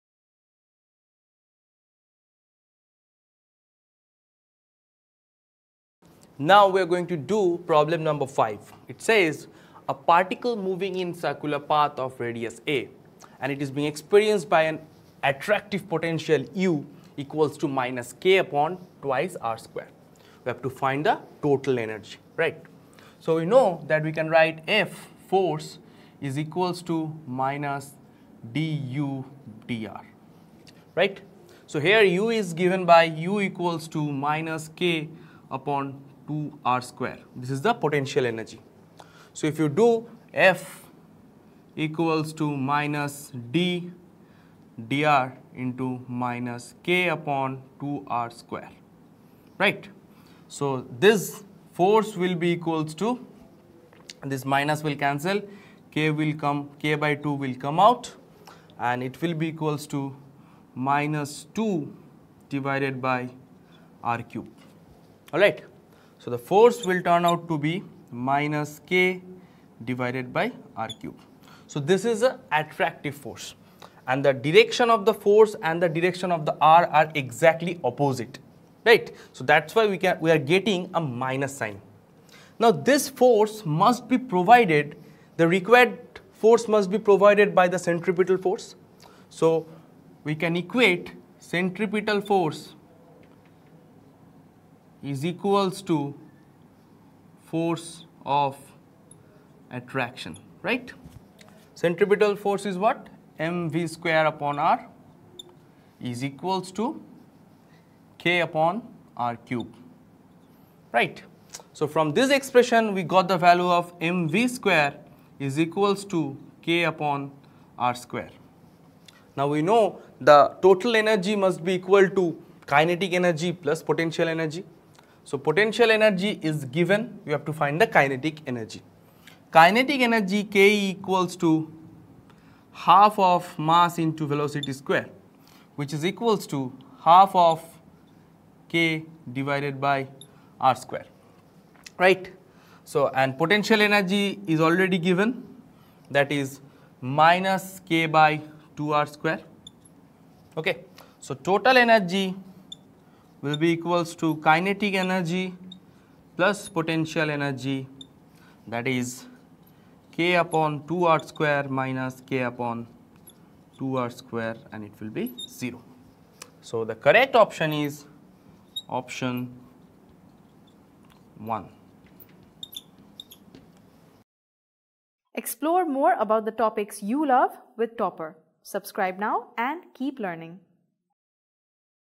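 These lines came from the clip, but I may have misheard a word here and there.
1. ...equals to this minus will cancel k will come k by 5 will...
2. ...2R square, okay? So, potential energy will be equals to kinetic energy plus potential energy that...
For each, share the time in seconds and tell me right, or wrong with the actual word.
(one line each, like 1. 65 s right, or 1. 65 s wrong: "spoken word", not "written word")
1. 52 s wrong: "2", not "5"
2. 148 s wrong: "total", not "potential".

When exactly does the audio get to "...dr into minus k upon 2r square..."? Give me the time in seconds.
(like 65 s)
44 s.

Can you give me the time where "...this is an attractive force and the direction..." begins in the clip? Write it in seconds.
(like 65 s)
71 s.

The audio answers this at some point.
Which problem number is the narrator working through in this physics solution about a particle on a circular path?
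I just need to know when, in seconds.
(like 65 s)
7 s.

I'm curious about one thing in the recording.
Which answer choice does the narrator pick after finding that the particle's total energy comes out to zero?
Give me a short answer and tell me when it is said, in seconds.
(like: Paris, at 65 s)
Option 1, at 168 s.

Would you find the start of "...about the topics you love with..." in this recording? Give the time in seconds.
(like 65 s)
176 s.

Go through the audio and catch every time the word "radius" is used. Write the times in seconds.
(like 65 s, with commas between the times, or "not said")
12 s.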